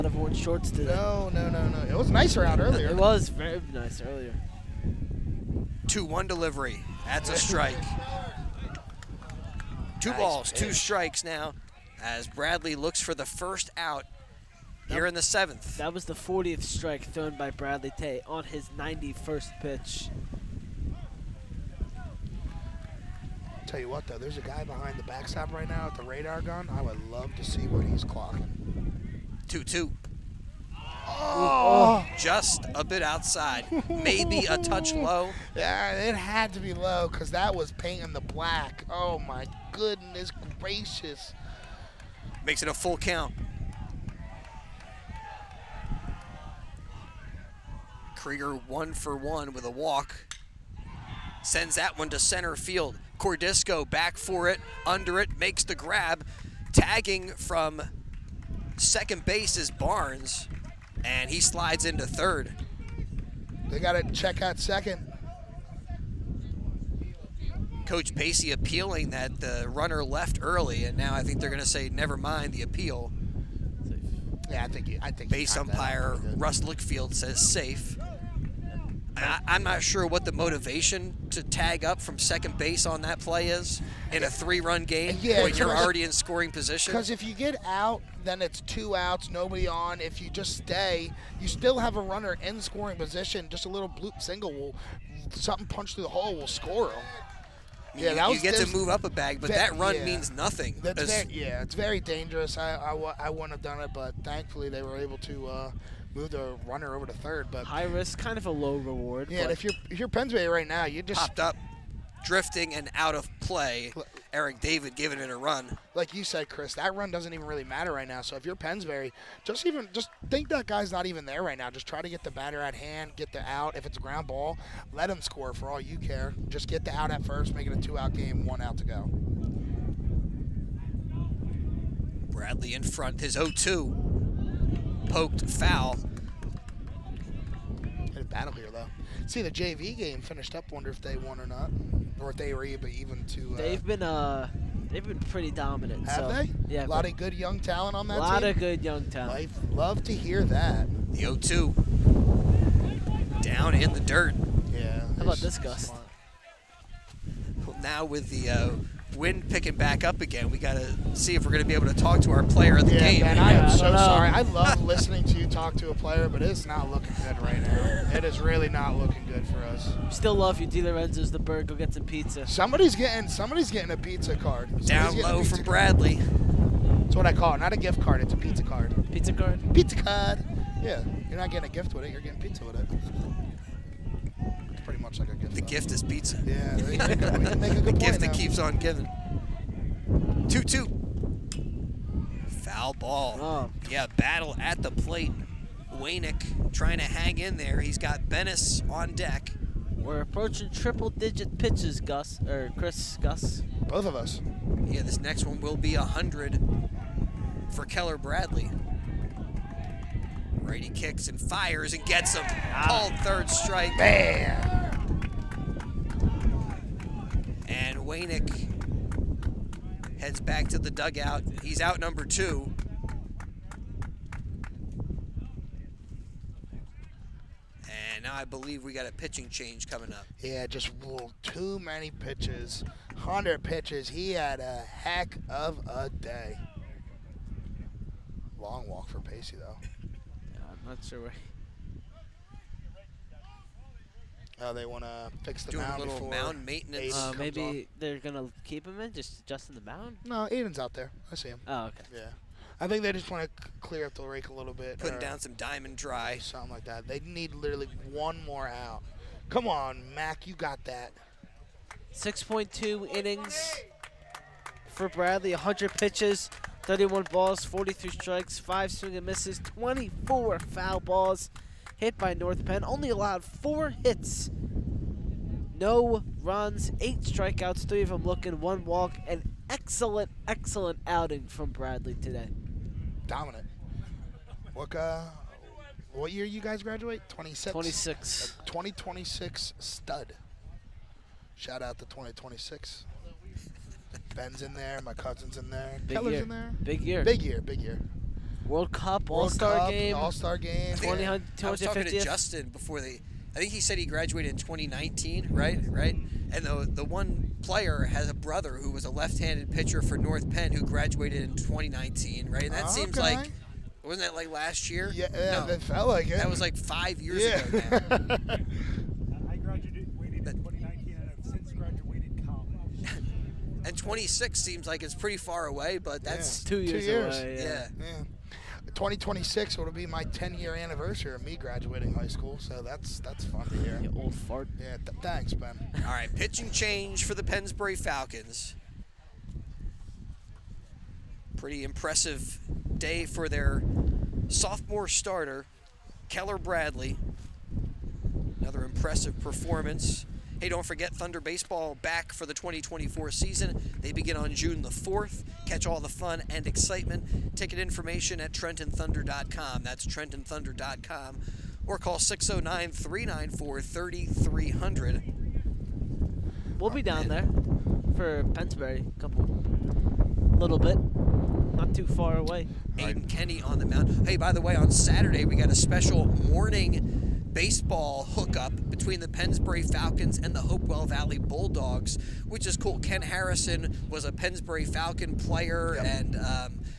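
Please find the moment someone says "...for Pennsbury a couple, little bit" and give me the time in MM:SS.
06:08.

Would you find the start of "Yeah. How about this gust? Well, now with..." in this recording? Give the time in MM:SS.
02:34.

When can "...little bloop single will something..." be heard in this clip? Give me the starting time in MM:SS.
01:33.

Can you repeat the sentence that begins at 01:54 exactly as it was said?
Eric David giving it a run.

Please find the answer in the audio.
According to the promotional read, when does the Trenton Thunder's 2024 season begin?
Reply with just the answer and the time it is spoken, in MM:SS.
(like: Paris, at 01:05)
June 4, at 05:54.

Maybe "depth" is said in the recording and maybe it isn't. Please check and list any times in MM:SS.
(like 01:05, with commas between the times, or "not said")
not said.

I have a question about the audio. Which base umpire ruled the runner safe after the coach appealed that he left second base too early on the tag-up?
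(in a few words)
Russ Lickfield.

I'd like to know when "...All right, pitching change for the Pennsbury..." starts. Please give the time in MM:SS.
05:36.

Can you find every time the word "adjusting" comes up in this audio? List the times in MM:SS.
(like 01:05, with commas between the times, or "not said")
04:09.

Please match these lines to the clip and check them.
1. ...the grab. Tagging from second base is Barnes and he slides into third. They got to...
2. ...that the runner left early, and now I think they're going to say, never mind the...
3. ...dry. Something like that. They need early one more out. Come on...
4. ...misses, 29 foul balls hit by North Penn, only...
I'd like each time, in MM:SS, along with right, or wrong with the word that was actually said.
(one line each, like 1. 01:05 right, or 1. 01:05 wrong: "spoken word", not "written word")
1. 00:55 right
2. 01:09 right
3. 04:15 wrong: "literally", not "early"
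4. 04:29 wrong: "24", not "29".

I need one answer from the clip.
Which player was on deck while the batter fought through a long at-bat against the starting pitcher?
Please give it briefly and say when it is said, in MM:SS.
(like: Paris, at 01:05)
Bennis, at 03:18.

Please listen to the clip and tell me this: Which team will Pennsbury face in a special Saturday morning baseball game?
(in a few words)
Hopewell Valley Bulldogs.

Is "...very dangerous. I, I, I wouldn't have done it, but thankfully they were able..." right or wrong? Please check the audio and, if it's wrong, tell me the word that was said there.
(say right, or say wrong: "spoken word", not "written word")
right.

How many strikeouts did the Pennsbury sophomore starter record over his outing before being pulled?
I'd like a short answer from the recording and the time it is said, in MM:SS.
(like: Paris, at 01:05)
8, at 04:36.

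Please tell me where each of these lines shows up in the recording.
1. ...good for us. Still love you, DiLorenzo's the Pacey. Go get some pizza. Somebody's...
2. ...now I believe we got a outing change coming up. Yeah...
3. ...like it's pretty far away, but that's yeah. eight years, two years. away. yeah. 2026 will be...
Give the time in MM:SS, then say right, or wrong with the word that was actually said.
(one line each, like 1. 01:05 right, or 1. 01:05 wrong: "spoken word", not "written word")
1. 02:49 wrong: "Burg", not "Pacey"
2. 03:48 wrong: "pitching", not "outing"
3. 05:24 wrong: "two", not "eight".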